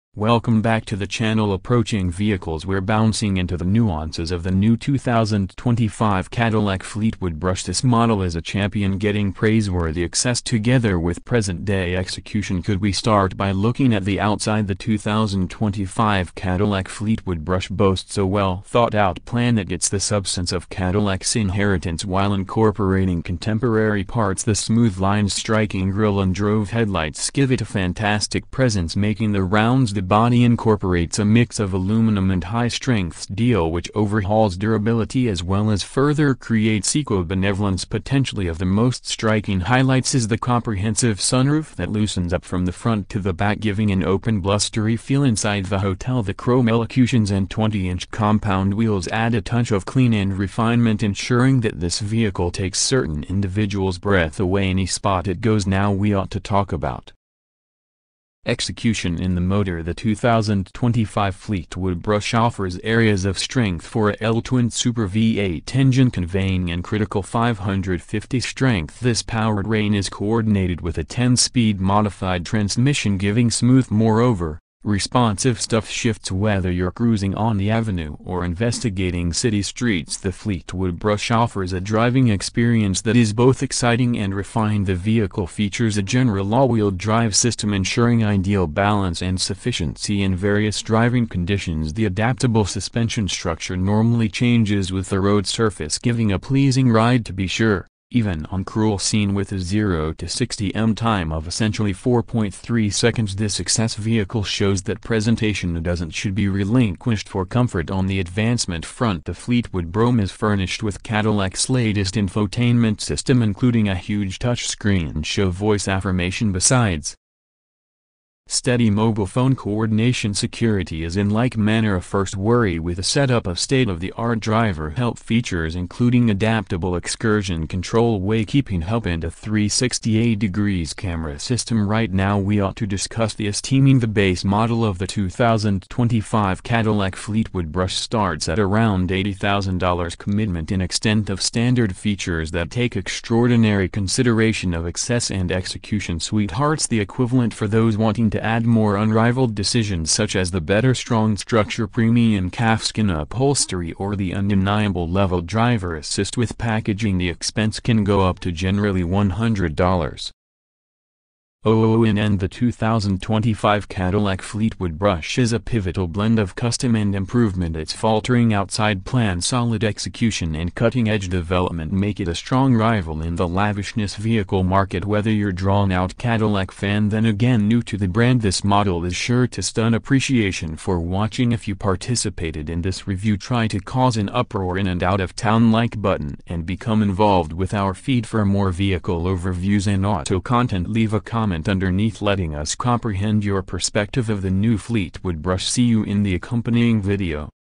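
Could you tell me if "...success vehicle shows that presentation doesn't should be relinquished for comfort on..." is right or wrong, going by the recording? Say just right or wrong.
right.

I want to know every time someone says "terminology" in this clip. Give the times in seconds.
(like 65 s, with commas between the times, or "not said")
not said.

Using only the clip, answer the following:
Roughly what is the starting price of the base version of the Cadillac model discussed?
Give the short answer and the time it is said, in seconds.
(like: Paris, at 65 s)
$80,000, at 139 s.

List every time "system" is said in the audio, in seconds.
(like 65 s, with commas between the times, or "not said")
87 s, 112 s, 131 s.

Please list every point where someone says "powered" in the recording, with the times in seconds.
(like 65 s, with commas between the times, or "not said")
69 s.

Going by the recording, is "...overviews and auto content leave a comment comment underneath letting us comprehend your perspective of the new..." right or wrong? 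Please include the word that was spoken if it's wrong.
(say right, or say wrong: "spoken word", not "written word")
right.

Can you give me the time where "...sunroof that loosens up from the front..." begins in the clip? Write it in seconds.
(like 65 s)
41 s.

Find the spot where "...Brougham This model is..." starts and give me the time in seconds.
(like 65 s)
7 s.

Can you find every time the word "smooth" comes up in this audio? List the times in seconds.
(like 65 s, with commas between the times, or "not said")
24 s, 73 s.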